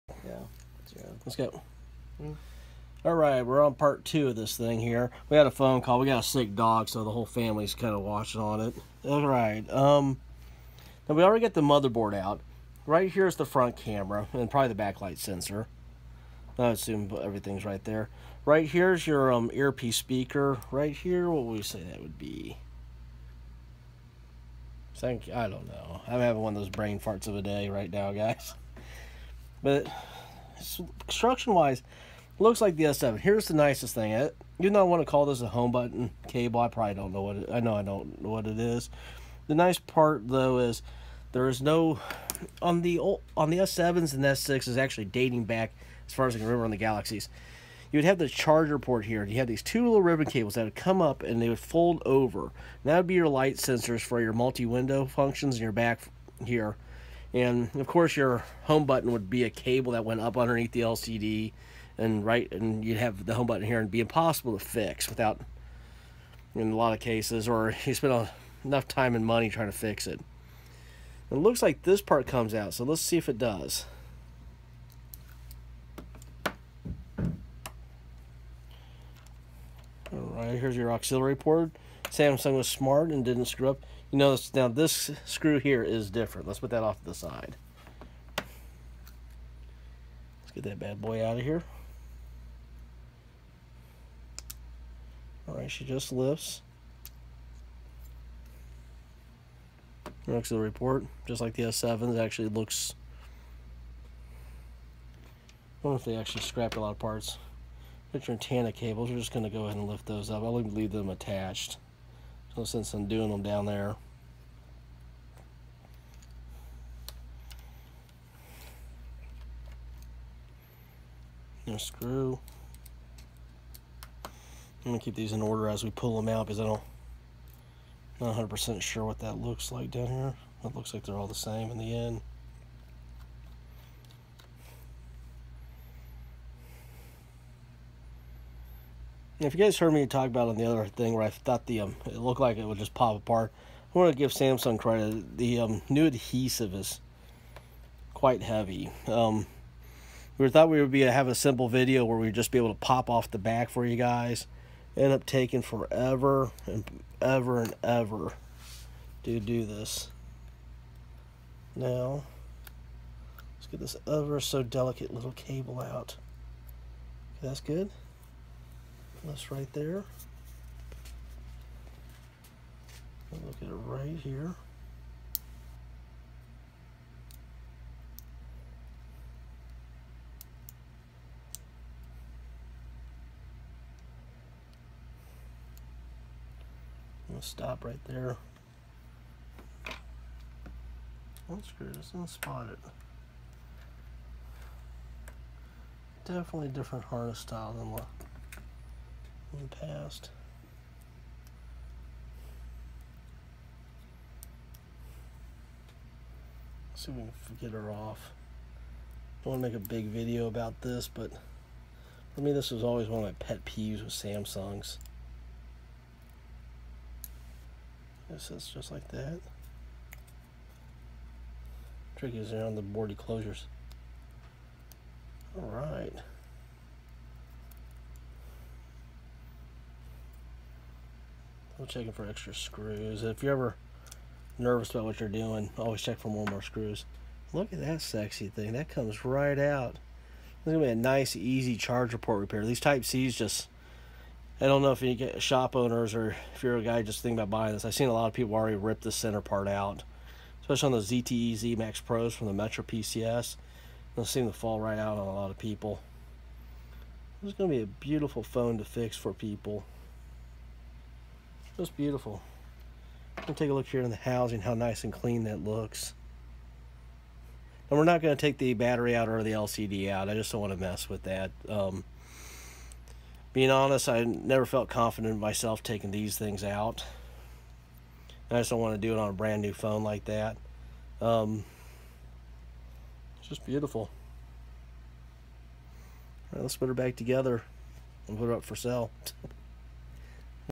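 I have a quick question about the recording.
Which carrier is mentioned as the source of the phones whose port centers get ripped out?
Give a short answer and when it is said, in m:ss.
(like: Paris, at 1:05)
Metro PCS, at 4:12.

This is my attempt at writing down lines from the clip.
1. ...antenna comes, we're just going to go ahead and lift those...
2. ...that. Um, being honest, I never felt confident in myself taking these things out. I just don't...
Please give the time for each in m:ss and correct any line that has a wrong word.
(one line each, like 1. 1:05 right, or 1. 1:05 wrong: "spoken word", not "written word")
1. 1:48 wrong: "cables", not "comes"
2. 4:31 right.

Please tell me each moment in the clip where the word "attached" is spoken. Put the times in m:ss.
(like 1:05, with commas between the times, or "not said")
1:51.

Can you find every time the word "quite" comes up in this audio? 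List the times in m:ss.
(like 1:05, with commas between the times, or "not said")
2:28.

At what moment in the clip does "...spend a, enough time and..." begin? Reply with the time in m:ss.
1:07.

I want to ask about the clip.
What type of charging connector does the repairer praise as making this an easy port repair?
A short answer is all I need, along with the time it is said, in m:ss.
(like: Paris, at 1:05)
Type C, at 4:02.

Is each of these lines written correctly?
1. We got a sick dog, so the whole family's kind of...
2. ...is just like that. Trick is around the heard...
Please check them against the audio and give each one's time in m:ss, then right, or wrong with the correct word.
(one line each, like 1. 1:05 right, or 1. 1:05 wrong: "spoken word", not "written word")
1. 0:05 right
2. 3:38 wrong: "board", not "heard".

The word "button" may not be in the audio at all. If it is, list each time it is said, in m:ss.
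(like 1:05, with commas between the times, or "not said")
0:35, 0:58, 1:03.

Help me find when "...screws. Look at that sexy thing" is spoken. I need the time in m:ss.
3:56.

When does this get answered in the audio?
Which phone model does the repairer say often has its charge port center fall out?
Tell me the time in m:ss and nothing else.
4:11.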